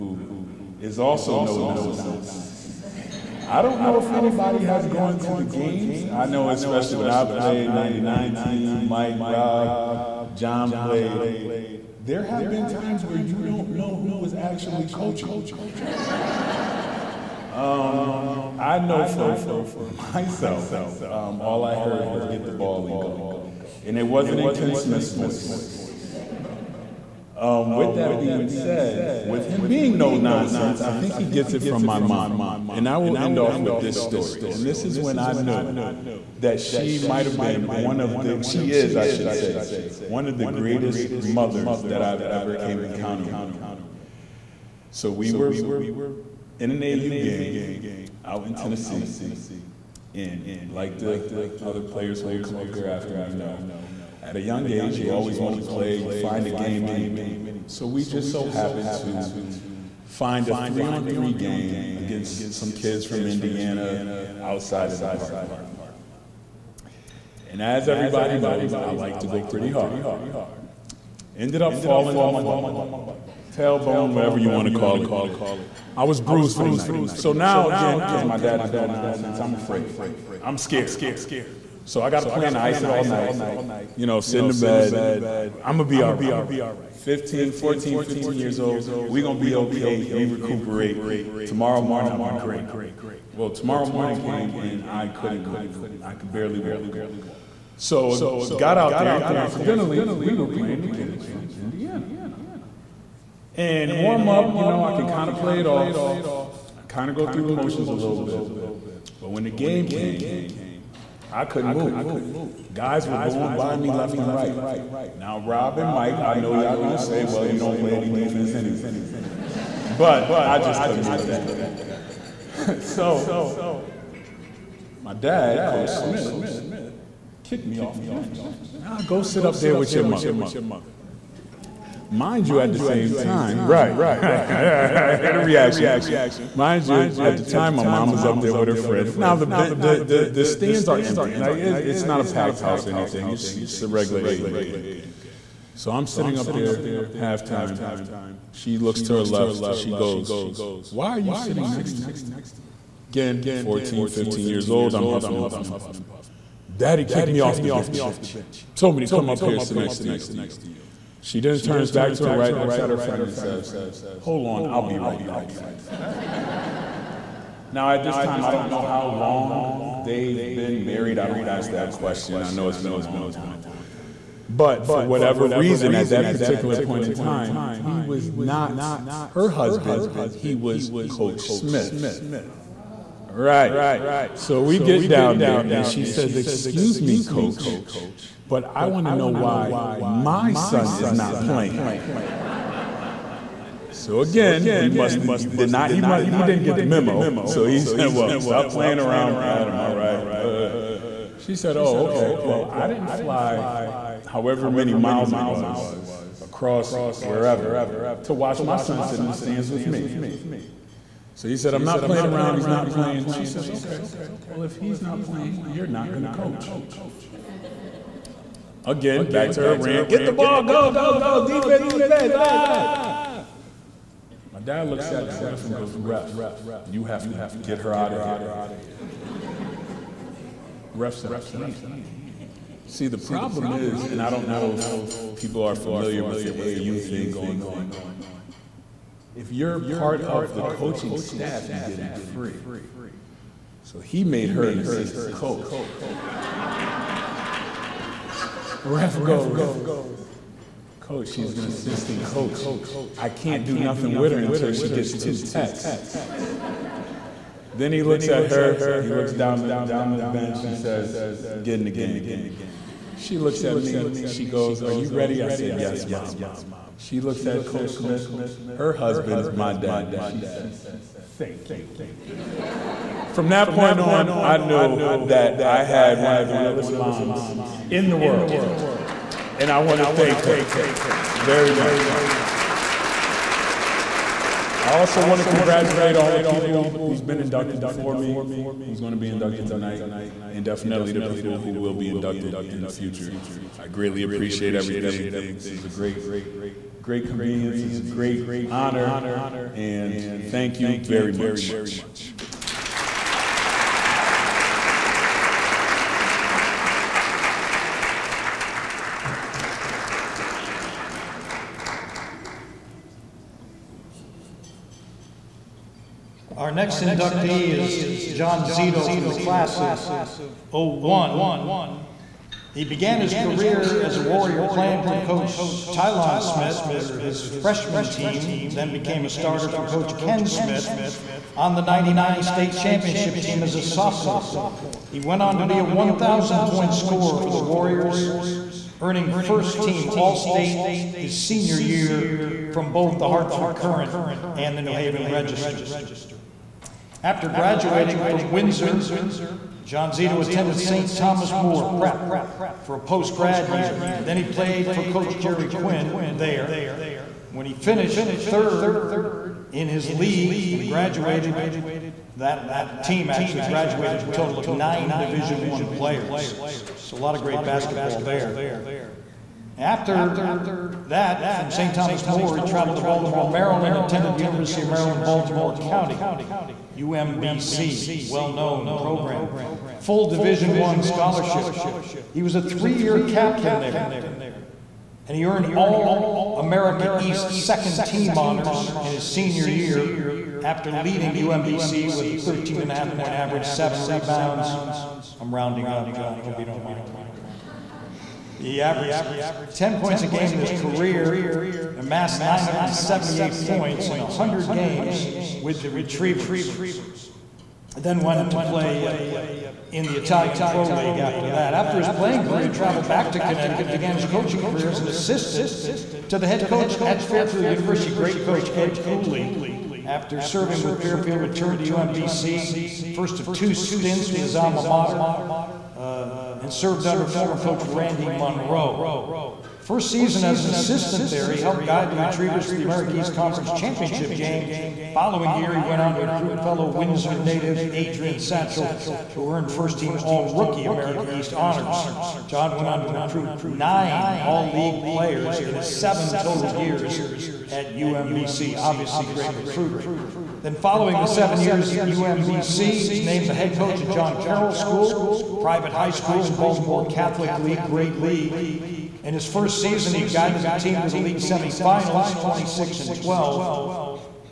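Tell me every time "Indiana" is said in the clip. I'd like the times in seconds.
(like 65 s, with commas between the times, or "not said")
63 s, 101 s.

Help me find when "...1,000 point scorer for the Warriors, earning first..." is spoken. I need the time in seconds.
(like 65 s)
335 s.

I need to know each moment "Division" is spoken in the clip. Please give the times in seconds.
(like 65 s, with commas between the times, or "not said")
365 s, 380 s.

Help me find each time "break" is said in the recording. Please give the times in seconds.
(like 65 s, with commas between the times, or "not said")
not said.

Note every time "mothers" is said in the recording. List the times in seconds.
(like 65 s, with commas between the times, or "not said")
41 s, 130 s.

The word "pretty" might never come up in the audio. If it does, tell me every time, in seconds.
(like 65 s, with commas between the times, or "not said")
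69 s.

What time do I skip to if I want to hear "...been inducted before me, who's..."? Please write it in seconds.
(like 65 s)
287 s.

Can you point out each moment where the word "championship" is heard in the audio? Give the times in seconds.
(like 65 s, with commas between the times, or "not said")
332 s, 433 s.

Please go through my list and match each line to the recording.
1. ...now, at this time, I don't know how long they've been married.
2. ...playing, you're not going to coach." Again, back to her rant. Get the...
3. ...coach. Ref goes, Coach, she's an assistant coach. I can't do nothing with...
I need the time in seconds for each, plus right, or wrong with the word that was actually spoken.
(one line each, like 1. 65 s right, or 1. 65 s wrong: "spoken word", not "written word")
1. 167 s right
2. 215 s right
3. 245 s right.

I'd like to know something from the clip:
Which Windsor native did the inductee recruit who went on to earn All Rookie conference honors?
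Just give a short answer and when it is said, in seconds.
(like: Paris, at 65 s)
Adrian Satchel, at 437 s.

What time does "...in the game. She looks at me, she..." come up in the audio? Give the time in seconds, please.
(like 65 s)
261 s.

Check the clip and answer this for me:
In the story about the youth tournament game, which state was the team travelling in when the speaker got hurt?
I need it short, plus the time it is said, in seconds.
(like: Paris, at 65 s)
Tennessee, at 48 s.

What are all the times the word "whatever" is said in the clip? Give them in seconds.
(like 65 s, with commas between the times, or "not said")
74 s, 175 s.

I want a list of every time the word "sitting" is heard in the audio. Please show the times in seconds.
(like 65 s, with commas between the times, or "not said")
146 s, 151 s.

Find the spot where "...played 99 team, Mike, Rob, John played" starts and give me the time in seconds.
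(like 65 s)
7 s.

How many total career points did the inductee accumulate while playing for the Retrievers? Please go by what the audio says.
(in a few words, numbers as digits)
978.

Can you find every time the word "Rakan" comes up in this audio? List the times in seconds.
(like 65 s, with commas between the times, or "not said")
not said.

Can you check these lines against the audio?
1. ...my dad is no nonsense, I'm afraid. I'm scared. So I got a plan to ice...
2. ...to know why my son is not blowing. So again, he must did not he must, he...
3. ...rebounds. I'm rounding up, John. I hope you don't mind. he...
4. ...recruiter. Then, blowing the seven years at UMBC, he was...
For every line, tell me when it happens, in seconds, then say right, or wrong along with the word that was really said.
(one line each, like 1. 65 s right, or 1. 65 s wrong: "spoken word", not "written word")
1. 78 s right
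2. 189 s wrong: "playing", not "blowing"
3. 394 s right
4. 449 s wrong: "following", not "blowing".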